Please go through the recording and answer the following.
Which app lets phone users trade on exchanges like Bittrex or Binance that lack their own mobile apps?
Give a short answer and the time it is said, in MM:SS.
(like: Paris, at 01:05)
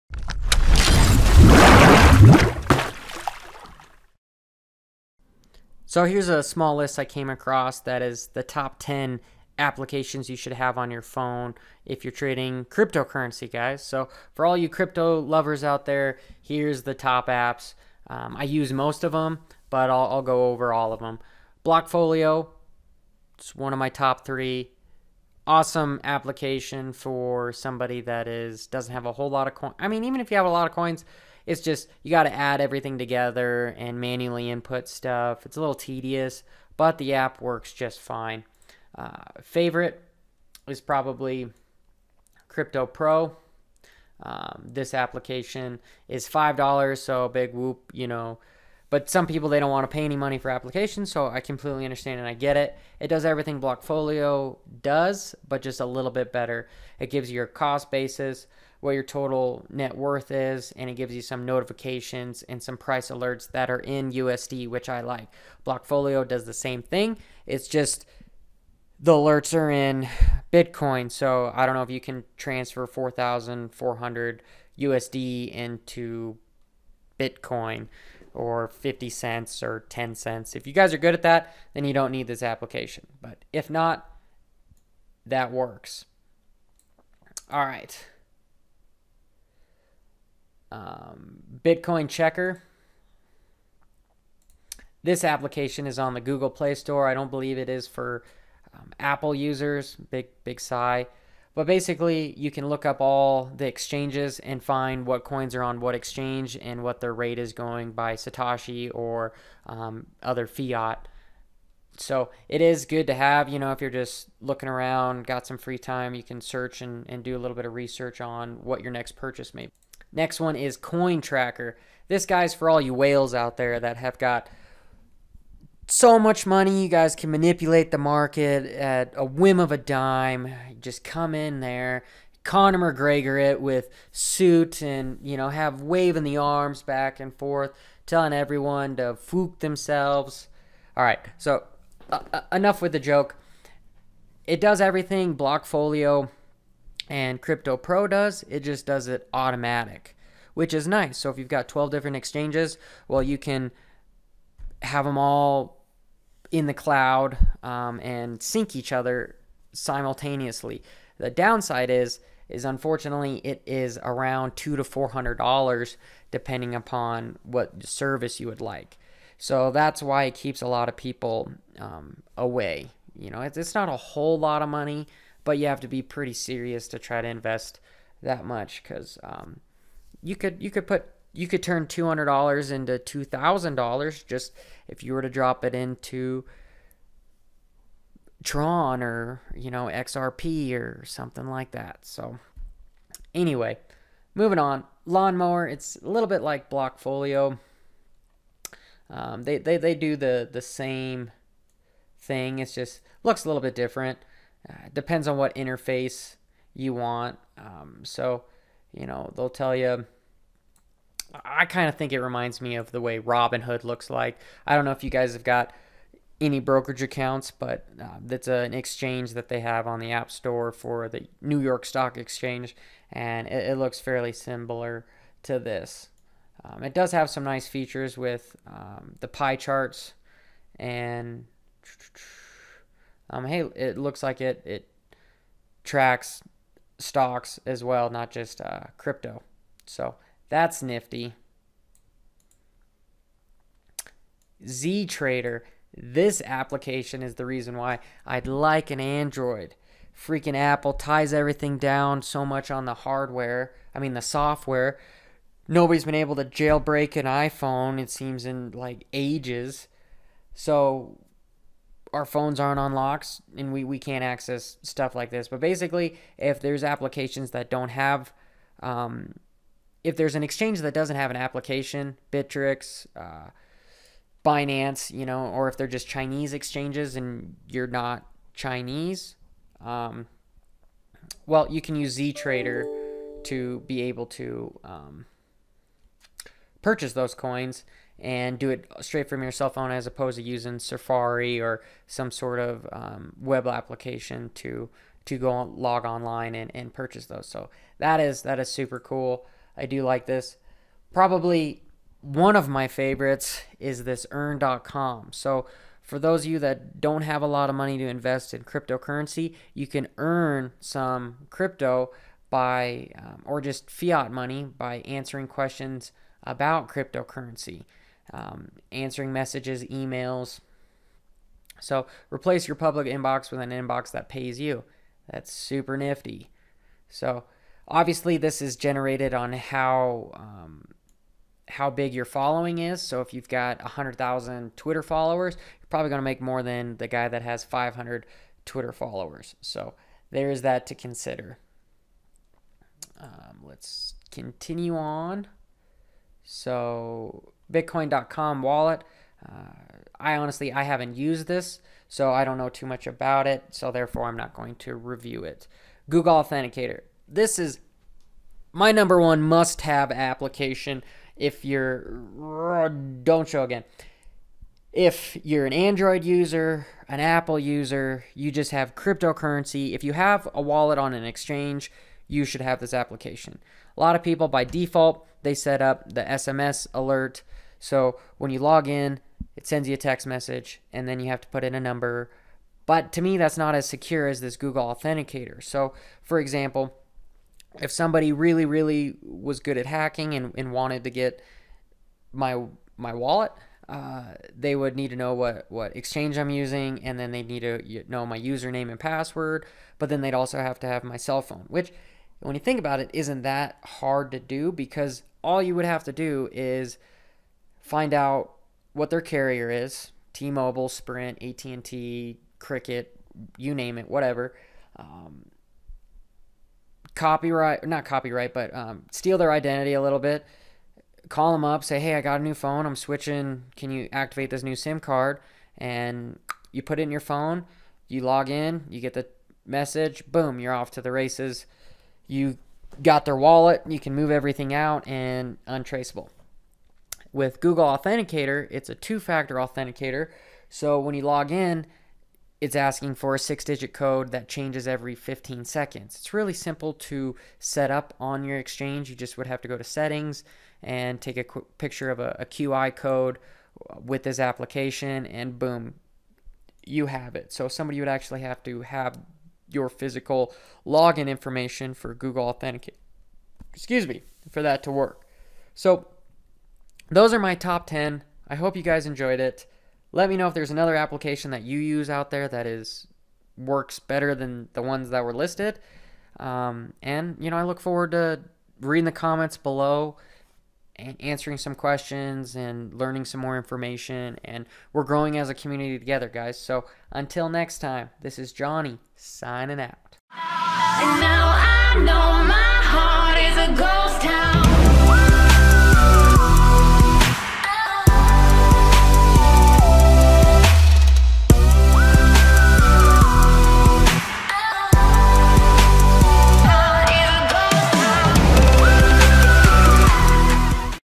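ZTrader, at 04:04.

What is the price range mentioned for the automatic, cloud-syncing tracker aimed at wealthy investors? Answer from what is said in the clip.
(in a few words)
$200 to $400.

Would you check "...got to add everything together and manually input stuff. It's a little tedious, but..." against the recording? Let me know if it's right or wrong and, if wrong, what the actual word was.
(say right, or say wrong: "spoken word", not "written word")
right.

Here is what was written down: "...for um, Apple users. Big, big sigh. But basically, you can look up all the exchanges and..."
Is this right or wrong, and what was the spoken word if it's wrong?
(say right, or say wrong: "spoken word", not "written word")
right.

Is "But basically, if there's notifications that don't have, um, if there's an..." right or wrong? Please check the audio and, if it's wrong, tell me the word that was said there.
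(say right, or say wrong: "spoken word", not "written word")
wrong: "applications", not "notifications".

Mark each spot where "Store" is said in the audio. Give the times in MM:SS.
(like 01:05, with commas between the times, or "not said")
01:36, 03:40.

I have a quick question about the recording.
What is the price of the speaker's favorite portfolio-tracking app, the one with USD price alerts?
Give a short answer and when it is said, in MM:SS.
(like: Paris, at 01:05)
$5, at 00:46.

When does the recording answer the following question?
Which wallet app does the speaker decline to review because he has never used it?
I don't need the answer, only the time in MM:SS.
05:47.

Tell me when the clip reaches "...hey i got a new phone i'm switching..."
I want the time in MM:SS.
07:01.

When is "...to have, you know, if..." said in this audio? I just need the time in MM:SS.
01:53.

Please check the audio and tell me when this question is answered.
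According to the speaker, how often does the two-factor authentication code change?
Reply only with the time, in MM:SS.
07:25.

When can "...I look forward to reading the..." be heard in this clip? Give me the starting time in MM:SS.
07:57.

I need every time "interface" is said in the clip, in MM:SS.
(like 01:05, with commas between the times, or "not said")
03:25.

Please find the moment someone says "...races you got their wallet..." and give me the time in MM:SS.
07:11.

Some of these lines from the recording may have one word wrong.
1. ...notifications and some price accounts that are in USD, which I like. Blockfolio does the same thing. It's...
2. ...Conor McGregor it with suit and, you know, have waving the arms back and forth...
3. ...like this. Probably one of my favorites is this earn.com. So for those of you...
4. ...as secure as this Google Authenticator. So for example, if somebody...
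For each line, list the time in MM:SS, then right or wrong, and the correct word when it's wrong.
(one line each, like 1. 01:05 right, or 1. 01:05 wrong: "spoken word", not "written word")
1. 01:01 wrong: "alerts", not "accounts"
2. 02:12 right
3. 05:00 right
4. 06:23 right.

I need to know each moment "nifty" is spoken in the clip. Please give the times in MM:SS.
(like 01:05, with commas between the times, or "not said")
04:00, 05:25.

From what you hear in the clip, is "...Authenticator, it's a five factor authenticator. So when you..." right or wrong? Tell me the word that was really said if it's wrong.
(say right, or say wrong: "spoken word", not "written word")
wrong: "two", not "five".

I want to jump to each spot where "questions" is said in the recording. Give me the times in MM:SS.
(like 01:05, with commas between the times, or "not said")
05:15, 08:01.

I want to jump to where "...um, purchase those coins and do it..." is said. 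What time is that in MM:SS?
04:44.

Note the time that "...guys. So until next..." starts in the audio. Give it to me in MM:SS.
08:06.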